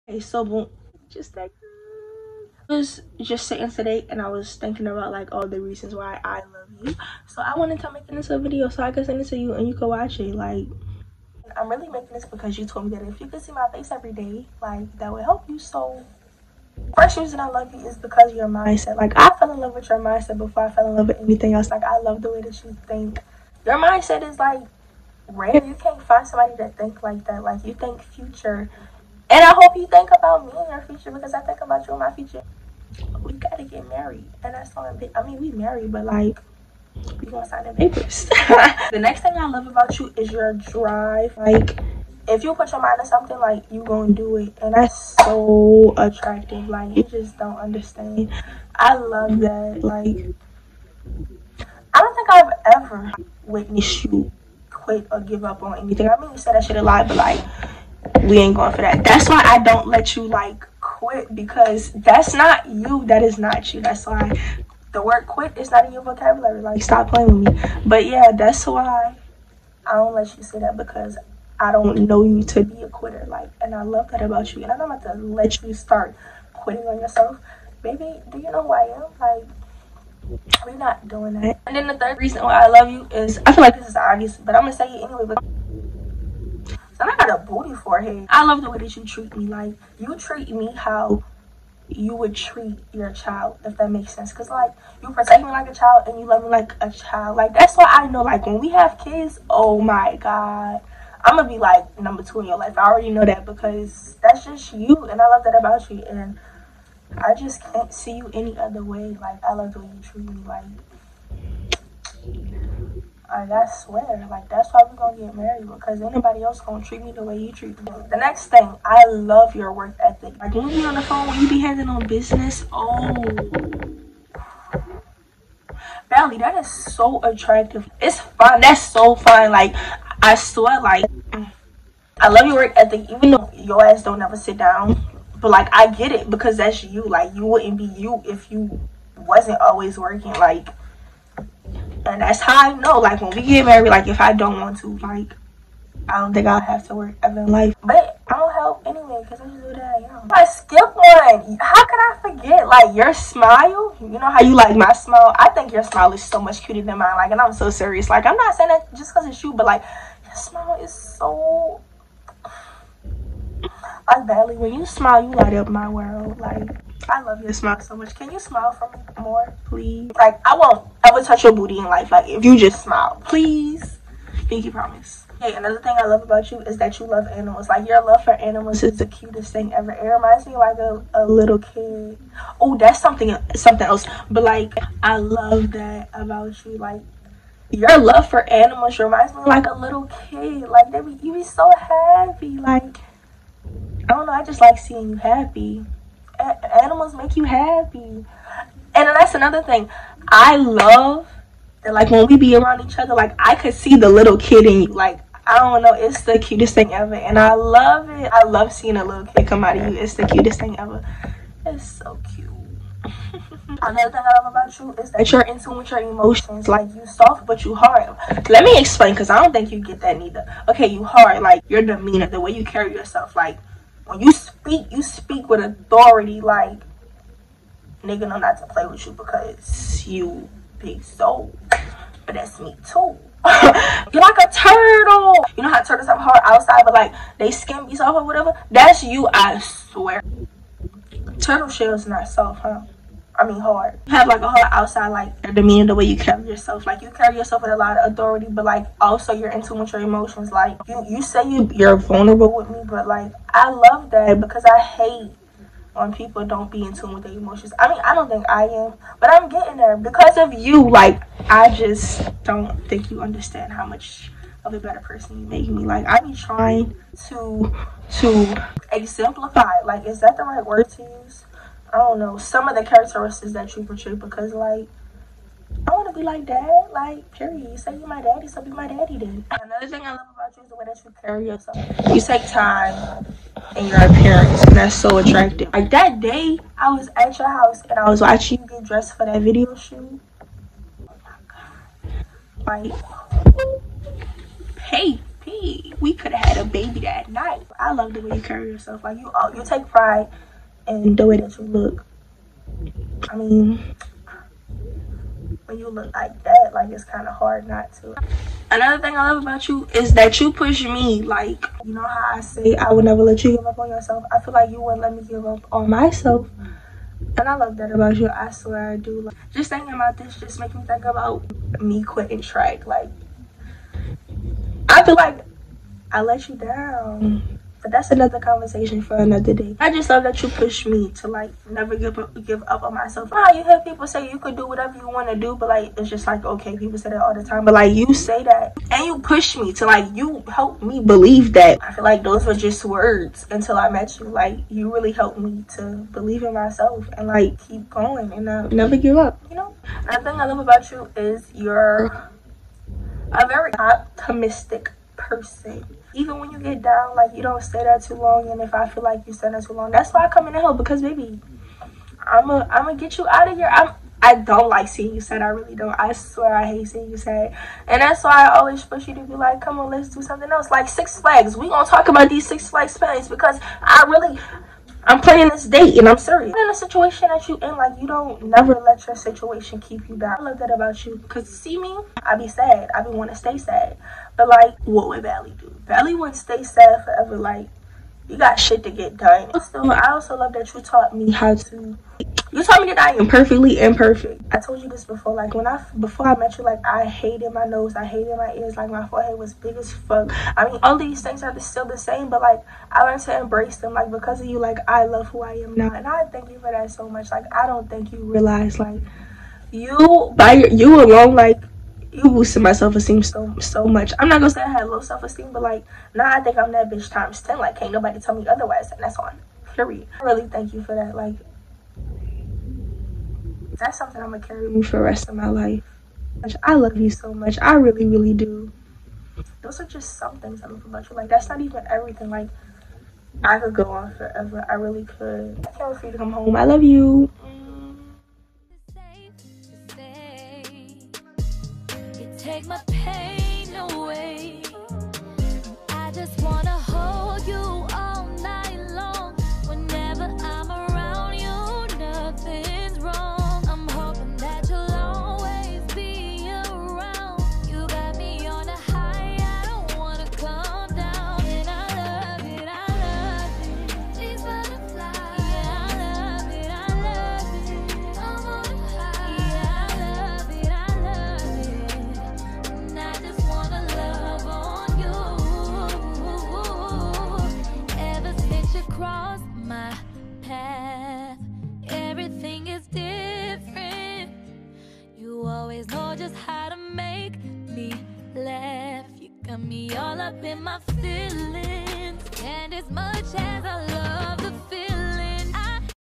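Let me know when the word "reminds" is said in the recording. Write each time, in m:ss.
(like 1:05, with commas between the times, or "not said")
3:00, 3:08.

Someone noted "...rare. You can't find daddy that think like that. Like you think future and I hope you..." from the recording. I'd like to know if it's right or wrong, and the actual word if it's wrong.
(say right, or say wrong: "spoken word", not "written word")
wrong: "somebody", not "daddy".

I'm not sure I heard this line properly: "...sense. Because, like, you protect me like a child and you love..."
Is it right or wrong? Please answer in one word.
right.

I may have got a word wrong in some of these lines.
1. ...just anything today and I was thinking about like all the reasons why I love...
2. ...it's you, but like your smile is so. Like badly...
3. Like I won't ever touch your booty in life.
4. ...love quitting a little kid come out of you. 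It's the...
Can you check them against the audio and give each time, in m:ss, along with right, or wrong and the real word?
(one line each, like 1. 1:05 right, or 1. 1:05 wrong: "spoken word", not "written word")
1. 0:03 wrong: "sitting", not "anything"
2. 2:39 right
3. 2:50 right
4. 3:28 wrong: "seeing", not "quitting".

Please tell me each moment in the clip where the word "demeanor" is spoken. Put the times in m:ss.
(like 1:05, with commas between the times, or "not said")
3:41, 4:05.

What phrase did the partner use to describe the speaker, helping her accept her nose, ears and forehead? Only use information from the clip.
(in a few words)
Perfectly imperfect.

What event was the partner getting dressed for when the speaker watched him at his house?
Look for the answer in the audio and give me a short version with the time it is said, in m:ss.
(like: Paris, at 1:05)
Video shoot, at 4:49.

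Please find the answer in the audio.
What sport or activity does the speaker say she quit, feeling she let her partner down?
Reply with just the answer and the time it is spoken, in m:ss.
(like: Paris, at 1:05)
Track, at 5:22.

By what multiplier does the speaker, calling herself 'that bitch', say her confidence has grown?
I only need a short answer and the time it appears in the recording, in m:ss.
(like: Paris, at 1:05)
10, at 6:57.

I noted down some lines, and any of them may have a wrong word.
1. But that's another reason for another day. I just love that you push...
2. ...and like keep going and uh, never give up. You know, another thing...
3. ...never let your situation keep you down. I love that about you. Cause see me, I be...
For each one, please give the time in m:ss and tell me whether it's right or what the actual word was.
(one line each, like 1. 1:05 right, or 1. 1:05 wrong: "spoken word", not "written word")
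1. 5:27 wrong: "conversation", not "reason"
2. 5:47 right
3. 6:18 right.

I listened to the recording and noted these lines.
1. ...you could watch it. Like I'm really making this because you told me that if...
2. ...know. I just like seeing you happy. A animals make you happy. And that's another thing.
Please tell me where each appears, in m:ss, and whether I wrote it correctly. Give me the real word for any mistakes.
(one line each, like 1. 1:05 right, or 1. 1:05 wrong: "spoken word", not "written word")
1. 0:09 right
2. 3:14 right.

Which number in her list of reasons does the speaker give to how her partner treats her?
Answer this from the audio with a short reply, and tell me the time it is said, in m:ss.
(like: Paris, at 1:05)
3, at 1:21.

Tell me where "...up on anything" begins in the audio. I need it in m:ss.
0:55.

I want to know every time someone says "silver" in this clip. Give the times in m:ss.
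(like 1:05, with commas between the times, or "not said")
not said.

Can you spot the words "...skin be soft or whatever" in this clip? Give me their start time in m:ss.
3:57.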